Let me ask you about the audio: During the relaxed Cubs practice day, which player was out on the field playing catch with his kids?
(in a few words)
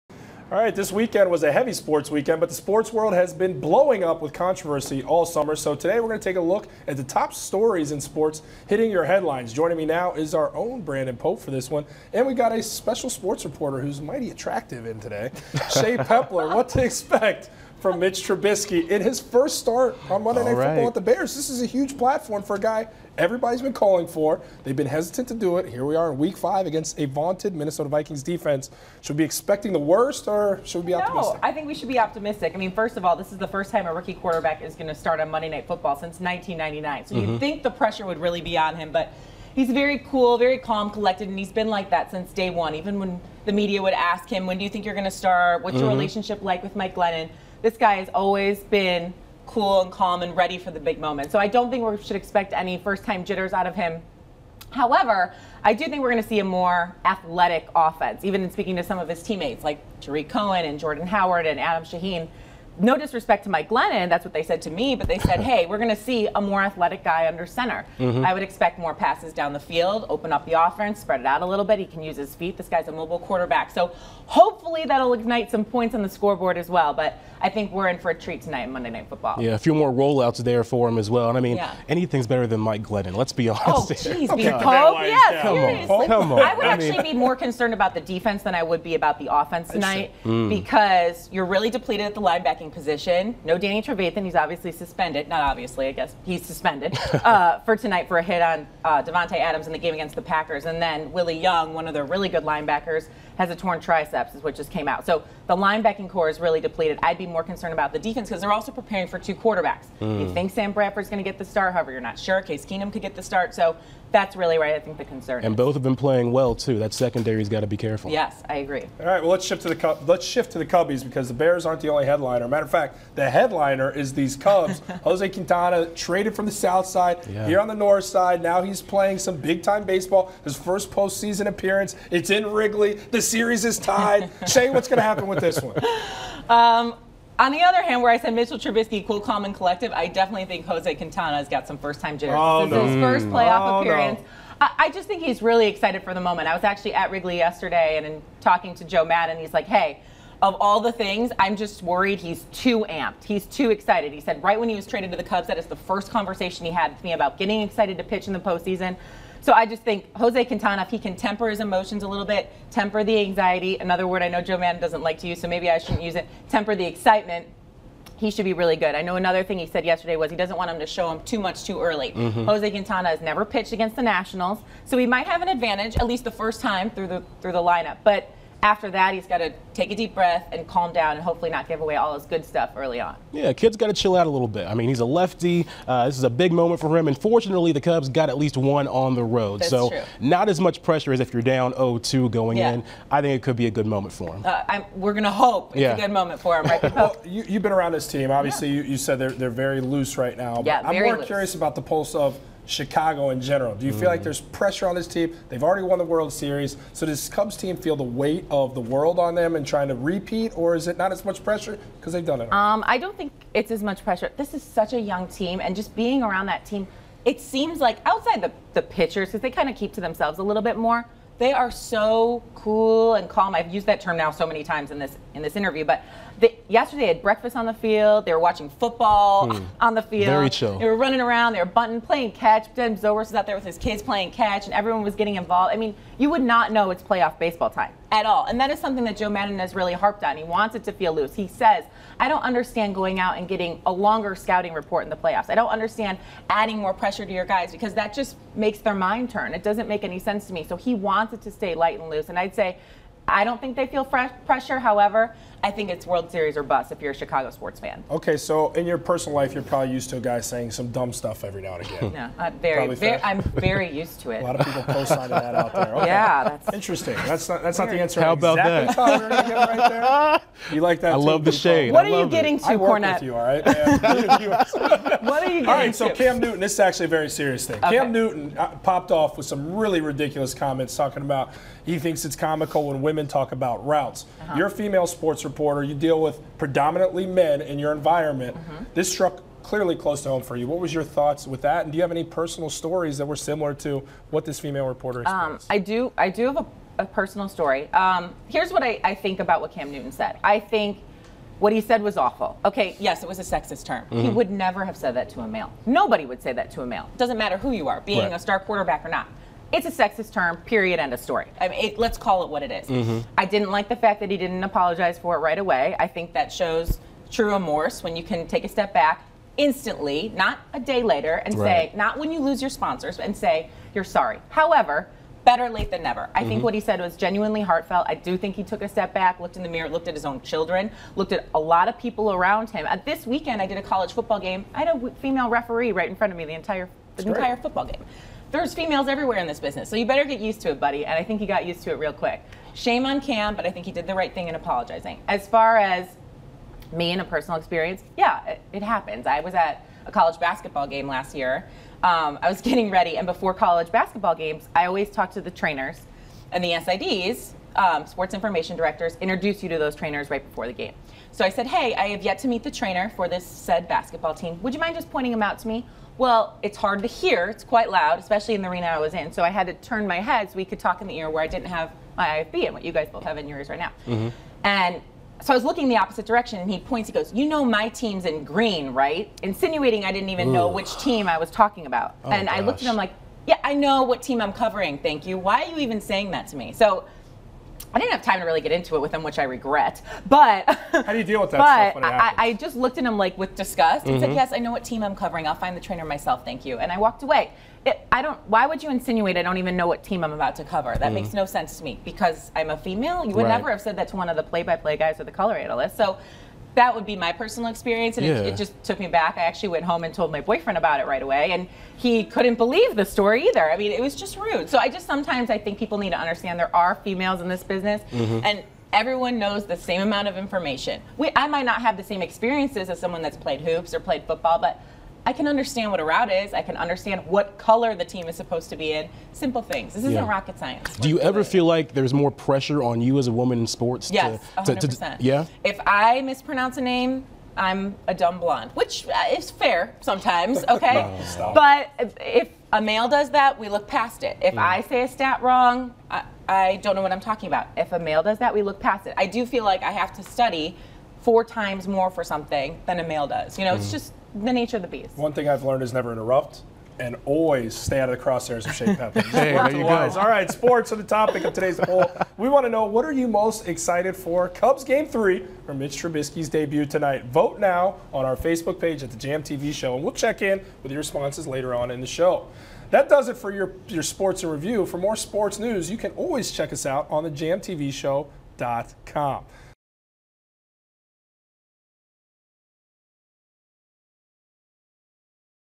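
Ben Zobrist.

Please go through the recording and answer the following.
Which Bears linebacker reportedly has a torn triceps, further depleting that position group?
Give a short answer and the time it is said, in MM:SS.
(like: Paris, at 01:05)
Willie Young, at 01:41.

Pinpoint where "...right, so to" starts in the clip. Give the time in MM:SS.
04:35.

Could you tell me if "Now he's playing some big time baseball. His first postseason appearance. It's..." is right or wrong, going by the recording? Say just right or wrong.
right.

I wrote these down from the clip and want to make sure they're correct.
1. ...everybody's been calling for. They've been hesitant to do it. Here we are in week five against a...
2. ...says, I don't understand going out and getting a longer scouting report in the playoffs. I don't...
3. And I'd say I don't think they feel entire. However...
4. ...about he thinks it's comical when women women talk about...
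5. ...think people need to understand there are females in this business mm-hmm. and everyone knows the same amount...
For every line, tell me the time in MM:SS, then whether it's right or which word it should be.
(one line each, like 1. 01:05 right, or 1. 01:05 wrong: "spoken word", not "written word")
1. 00:23 right
2. 04:01 right
3. 04:12 wrong: "pressure", not "entire"
4. 04:41 right
5. 06:55 right.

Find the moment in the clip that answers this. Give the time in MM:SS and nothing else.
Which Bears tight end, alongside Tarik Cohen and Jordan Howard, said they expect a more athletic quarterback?
01:01.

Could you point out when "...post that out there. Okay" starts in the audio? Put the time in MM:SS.
04:24.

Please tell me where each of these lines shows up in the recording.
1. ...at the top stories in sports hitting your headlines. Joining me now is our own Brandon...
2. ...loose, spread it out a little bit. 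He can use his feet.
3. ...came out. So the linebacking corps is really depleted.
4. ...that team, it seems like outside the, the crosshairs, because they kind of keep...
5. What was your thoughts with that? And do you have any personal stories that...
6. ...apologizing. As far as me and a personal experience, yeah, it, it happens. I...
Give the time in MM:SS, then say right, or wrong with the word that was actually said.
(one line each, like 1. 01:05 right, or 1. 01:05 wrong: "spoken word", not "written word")
1. 00:06 right
2. 01:10 wrong: "offense", not "loose"
3. 01:44 right
4. 03:36 wrong: "pitchers", not "crosshairs"
5. 04:50 right
6. 05:44 right.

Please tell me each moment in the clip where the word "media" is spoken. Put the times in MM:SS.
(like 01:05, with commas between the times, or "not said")
00:43.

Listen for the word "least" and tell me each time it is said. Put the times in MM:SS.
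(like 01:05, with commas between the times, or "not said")
02:56, 03:08.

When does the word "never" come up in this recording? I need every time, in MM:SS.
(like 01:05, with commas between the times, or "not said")
02:53, 05:04, 05:26, 06:43, 07:35.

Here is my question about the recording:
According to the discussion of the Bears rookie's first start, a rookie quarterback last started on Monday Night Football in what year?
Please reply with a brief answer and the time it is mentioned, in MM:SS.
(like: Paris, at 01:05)
1999, at 00:36.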